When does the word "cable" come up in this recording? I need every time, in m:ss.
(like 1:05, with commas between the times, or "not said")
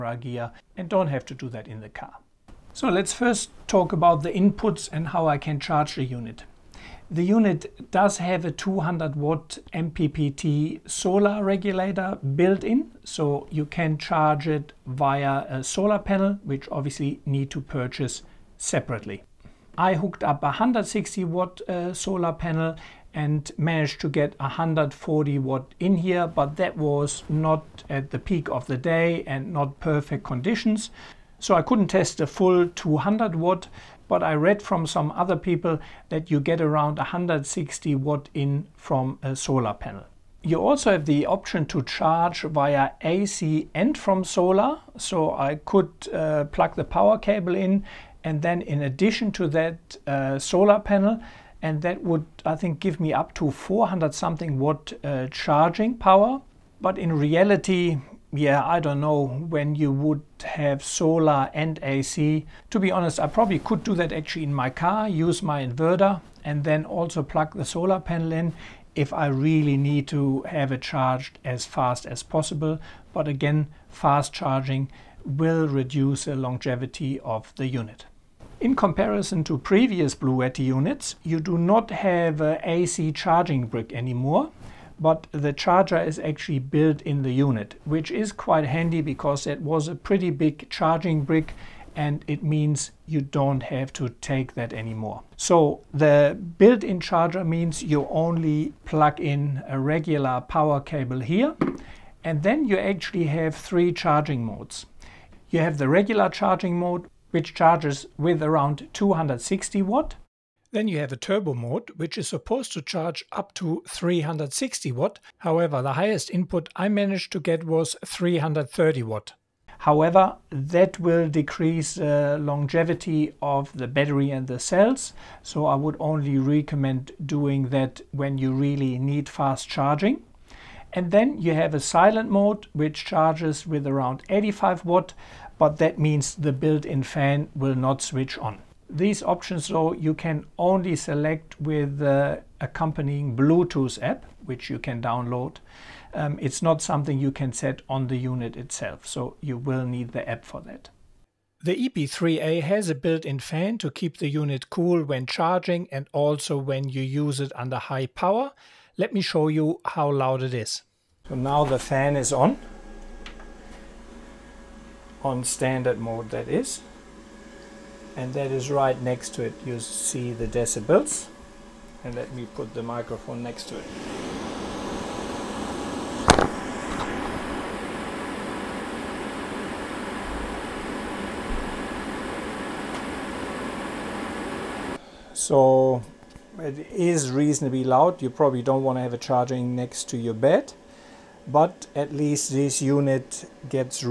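0:47, 1:40.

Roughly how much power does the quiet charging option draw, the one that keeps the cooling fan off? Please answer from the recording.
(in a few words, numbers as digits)
85 watt.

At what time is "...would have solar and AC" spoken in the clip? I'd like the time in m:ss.
0:59.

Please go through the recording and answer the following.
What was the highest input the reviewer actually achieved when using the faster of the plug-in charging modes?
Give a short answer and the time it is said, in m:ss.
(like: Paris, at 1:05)
330 watt, at 1:58.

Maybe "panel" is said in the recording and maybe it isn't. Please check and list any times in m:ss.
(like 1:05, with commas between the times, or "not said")
0:15, 0:22, 0:39, 0:50, 1:07.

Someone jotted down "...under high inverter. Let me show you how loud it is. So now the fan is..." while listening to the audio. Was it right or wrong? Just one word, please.
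wrong.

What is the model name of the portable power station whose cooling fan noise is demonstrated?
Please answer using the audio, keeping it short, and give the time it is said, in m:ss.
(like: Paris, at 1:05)
EB3A, at 2:31.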